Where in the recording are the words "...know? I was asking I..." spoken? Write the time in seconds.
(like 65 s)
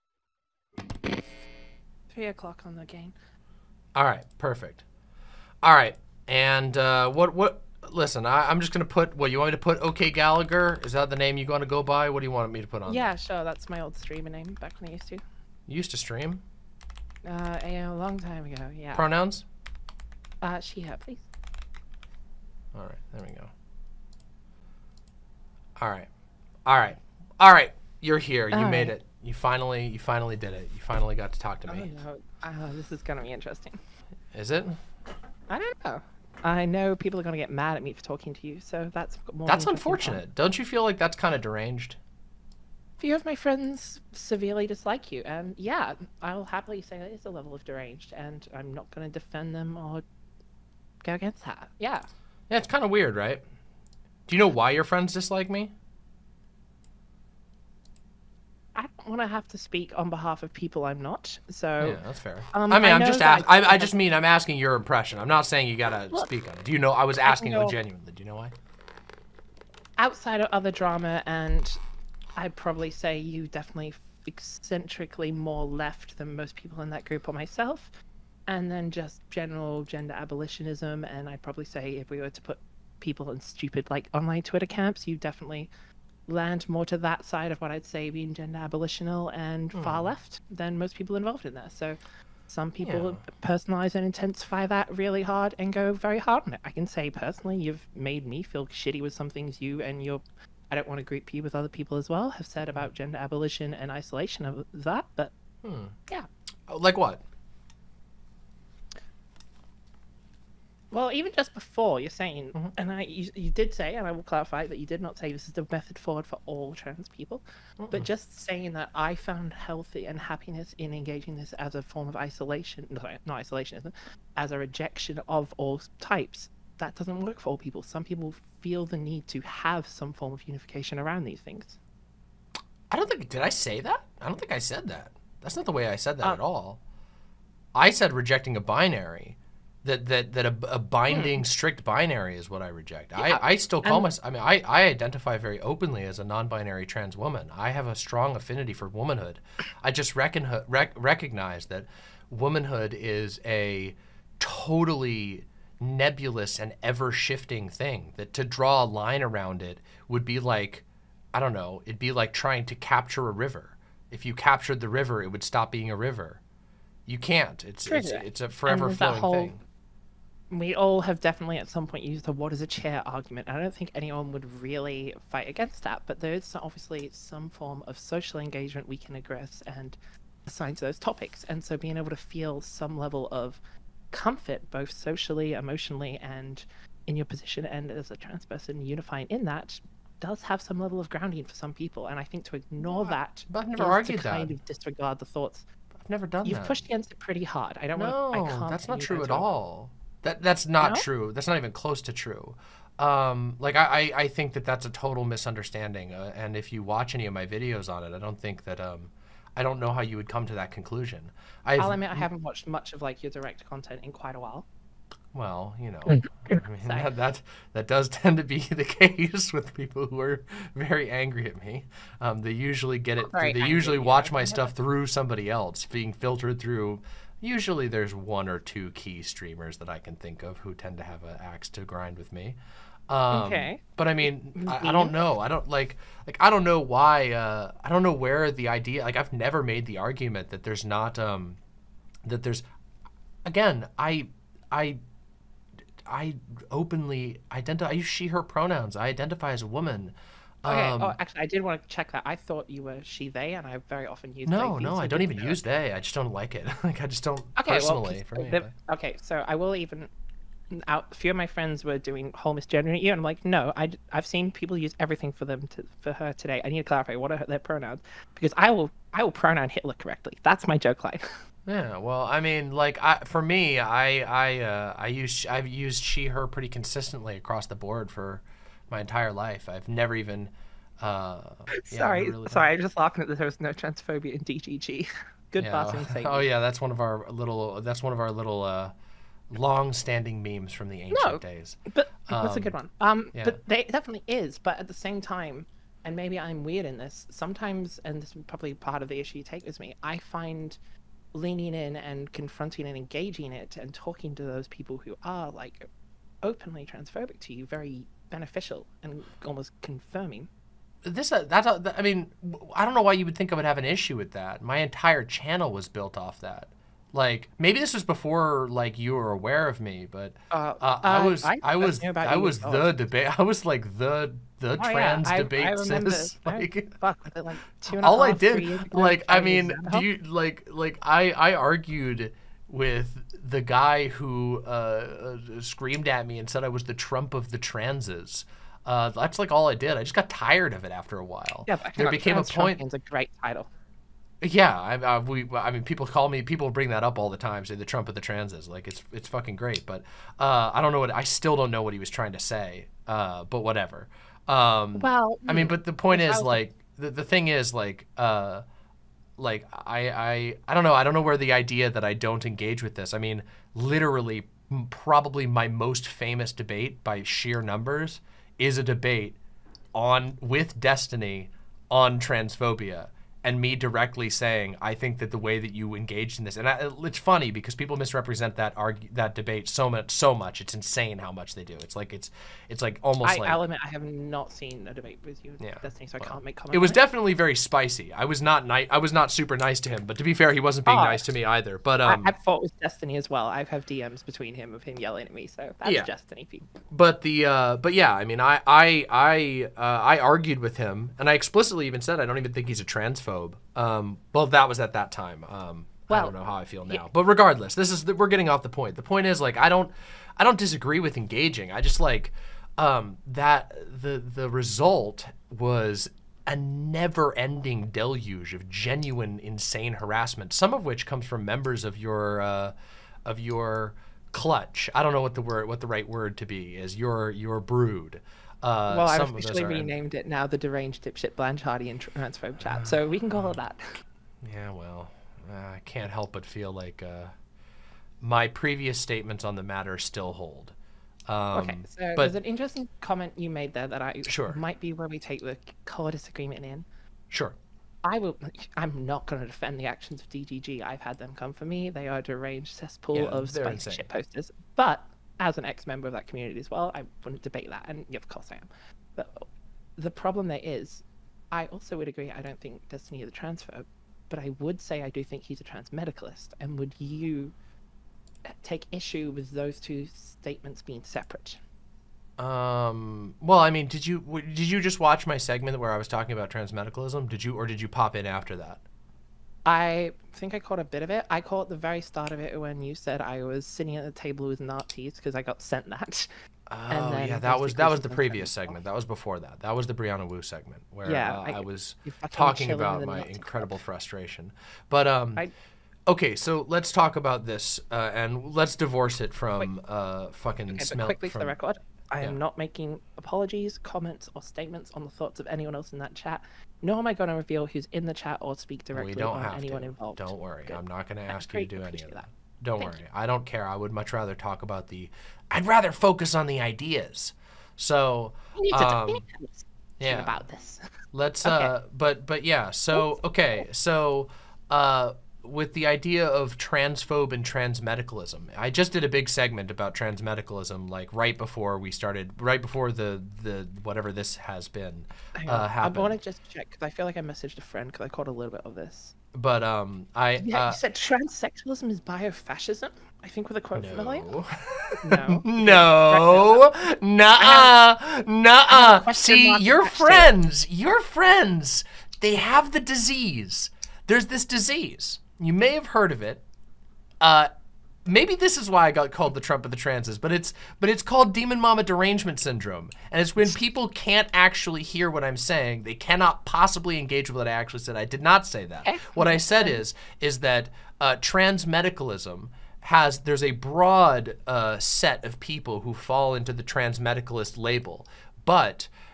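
66 s.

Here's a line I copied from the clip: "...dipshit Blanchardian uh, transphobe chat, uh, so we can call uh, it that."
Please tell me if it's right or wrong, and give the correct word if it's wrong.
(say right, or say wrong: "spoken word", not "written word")
right.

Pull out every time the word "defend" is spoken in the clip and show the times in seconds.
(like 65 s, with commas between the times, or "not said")
49 s, 449 s.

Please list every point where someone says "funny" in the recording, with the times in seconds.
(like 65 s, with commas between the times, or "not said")
377 s.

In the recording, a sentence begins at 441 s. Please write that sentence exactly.
Um, okay, so but, there's an interesting comment you made there that I sure.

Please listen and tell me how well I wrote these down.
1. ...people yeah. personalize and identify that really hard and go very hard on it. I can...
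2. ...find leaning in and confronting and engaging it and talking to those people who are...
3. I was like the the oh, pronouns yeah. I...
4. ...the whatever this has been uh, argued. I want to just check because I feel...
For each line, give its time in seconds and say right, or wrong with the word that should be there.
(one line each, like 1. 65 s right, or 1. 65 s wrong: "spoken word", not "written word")
1. 92 s wrong: "intensify", not "identify"
2. 300 s right
3. 323 s wrong: "trans", not "pronouns"
4. 533 s wrong: "happened", not "argued".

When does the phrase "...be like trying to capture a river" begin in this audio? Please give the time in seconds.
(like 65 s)
161 s.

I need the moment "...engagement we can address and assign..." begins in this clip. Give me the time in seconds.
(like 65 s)
178 s.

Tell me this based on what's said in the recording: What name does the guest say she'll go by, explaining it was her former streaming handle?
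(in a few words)
Gallagher.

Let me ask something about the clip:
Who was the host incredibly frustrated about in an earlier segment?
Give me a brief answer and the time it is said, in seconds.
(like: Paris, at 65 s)
Brianna Wu, at 489 s.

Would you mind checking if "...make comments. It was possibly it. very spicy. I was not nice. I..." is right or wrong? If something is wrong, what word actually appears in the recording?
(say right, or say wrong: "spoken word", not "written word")
wrong: "definitely", not "possibly".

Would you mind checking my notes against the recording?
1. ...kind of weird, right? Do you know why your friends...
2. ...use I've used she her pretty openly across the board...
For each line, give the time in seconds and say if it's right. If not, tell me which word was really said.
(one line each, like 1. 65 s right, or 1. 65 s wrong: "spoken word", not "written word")
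1. 52 s right
2. 275 s wrong: "consistently", not "openly".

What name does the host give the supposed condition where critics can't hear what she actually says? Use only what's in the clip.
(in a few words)
demon mama derangement syndrome.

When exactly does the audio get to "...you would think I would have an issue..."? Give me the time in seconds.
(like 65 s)
313 s.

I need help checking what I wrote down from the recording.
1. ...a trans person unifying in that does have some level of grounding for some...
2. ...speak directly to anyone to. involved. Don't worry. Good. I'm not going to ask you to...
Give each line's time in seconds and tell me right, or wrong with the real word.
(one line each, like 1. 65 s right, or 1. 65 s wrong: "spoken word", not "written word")
1. 188 s right
2. 508 s right.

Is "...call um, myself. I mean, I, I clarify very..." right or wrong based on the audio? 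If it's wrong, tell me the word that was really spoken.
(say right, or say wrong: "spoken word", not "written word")
wrong: "identify", not "clarify".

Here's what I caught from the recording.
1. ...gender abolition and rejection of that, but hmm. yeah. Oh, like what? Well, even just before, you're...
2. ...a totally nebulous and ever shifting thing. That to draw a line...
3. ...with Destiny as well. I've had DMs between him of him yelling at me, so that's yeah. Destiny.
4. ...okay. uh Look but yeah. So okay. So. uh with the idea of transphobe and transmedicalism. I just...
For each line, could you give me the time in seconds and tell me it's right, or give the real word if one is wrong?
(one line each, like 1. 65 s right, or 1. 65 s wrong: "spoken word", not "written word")
1. 102 s wrong: "isolation", not "rejection"
2. 153 s right
3. 392 s right
4. 521 s wrong: "But", not "Look".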